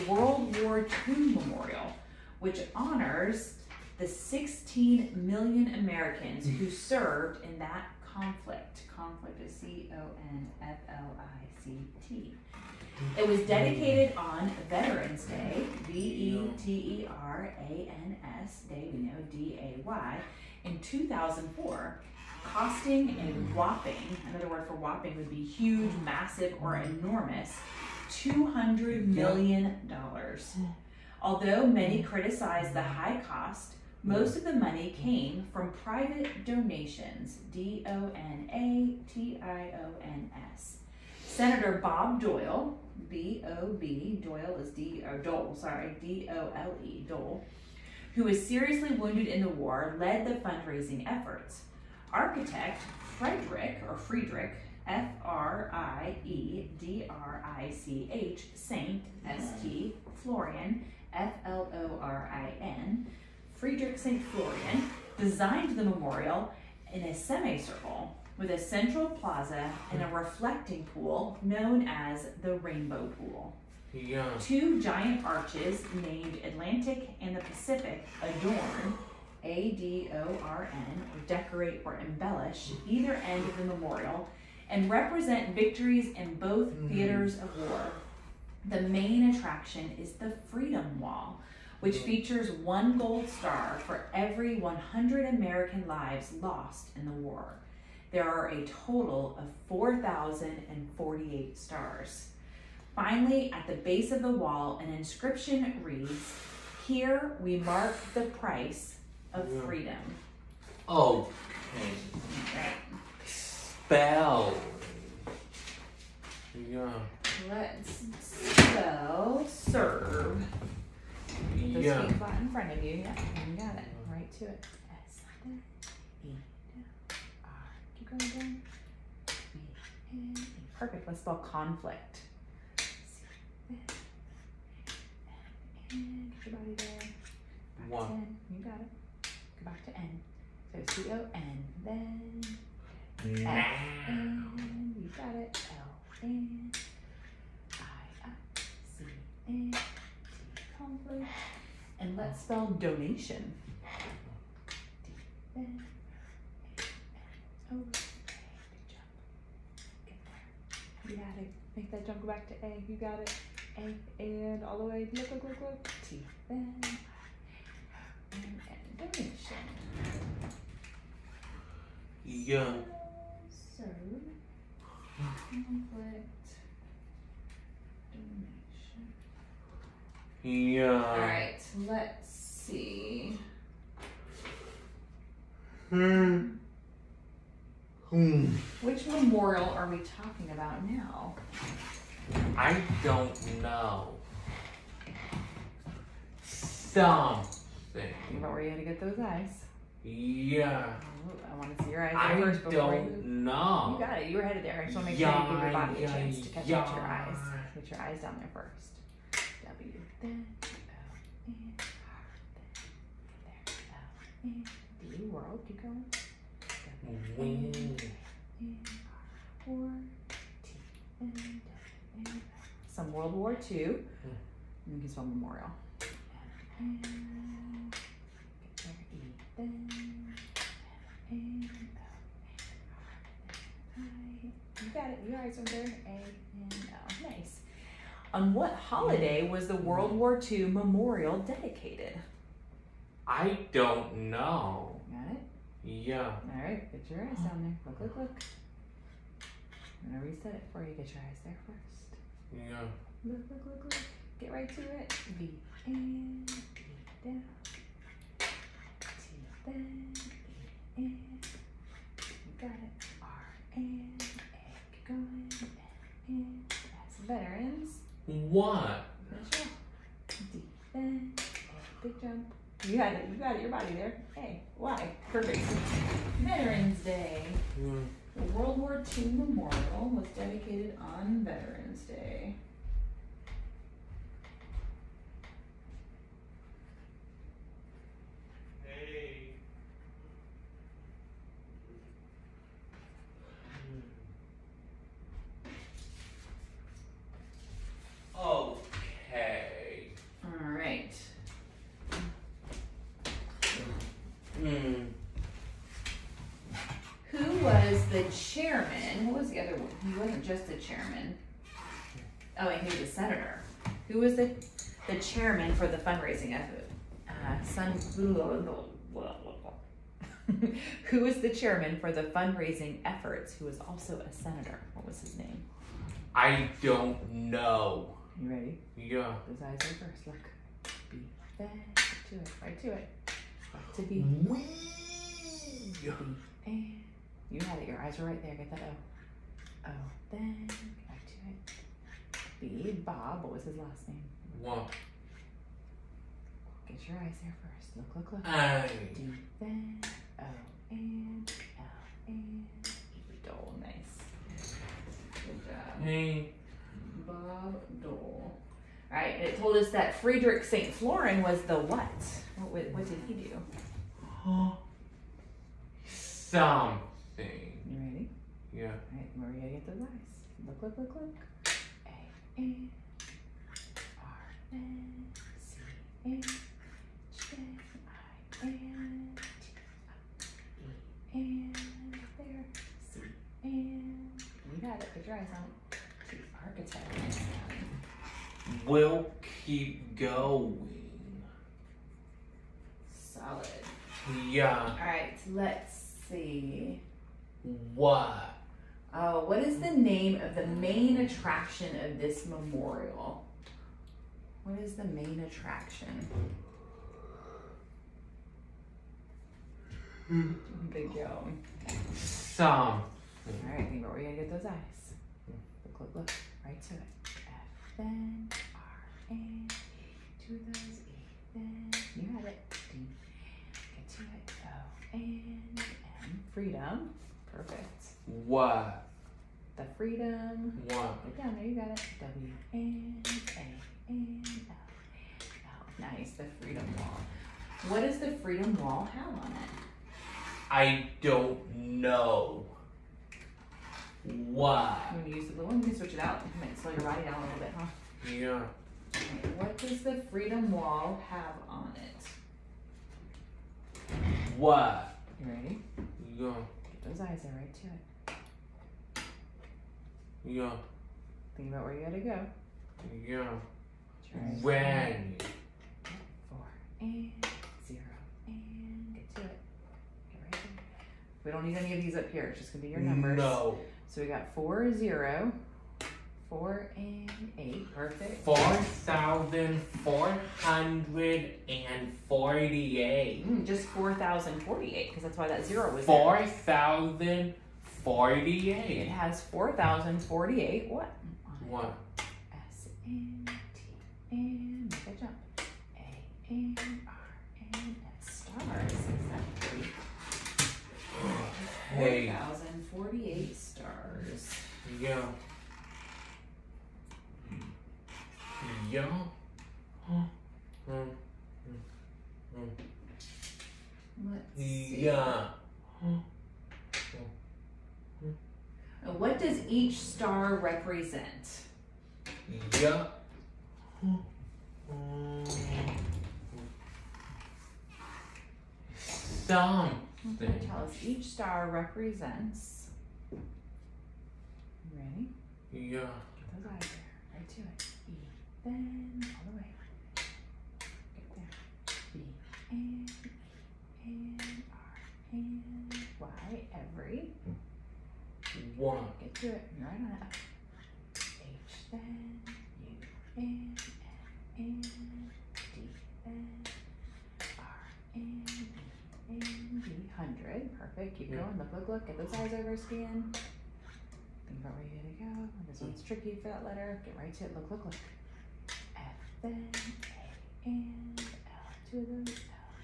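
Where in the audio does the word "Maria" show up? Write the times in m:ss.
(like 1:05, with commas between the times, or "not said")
6:09.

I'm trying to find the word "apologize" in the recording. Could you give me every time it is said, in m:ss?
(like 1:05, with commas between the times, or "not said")
not said.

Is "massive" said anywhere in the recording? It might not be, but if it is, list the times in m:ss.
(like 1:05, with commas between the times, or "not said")
0:26.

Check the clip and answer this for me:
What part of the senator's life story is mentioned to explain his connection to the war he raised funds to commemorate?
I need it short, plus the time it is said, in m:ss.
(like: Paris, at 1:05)
Seriously wounded in the war, at 0:48.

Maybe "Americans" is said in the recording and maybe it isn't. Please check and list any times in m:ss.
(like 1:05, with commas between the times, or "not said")
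0:05, 1:35.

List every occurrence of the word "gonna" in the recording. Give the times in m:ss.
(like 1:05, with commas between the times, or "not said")
4:10, 6:54, 7:25, 7:52, 9:25.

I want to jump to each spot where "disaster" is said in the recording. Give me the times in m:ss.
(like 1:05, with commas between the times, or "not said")
not said.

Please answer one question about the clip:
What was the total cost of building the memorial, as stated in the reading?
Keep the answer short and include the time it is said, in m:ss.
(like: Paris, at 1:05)
$200 million, at 0:28.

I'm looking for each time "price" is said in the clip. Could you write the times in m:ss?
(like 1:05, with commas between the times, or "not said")
1:48.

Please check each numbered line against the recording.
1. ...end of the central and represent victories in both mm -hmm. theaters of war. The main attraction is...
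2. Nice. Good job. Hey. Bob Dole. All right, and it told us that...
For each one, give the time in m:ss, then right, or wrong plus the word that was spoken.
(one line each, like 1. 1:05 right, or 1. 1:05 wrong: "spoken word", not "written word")
1. 1:23 wrong: "memorial", not "central"
2. 5:53 right.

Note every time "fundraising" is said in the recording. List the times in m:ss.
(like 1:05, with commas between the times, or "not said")
0:50, 5:15, 5:22.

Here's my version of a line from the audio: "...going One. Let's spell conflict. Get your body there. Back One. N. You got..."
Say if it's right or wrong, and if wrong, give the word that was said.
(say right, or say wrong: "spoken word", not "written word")
wrong: "Perfect", not "One".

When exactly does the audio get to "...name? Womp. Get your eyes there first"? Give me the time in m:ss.
5:44.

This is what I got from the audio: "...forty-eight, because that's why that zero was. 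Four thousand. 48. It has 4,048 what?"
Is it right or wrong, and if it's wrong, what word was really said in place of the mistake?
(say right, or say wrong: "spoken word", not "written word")
right.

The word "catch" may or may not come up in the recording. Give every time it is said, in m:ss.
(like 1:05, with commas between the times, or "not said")
3:26.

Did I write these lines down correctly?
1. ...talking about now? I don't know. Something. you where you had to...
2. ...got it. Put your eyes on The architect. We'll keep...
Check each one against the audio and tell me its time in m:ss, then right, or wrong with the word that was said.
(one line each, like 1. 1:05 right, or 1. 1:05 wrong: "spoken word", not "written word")
1. 3:09 right
2. 6:24 right.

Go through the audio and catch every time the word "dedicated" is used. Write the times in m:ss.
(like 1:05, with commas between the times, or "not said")
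0:13, 4:01, 4:40.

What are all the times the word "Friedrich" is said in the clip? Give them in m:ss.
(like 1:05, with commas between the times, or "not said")
0:53, 1:03, 6:00.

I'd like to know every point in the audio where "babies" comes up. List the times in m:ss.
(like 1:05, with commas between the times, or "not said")
not said.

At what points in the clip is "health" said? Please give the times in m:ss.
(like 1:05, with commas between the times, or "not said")
not said.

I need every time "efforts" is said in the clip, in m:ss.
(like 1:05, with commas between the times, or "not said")
0:51, 5:16, 5:23.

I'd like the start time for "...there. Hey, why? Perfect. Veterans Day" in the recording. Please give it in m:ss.
4:33.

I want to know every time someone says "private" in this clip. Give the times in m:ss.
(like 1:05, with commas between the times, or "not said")
0:35.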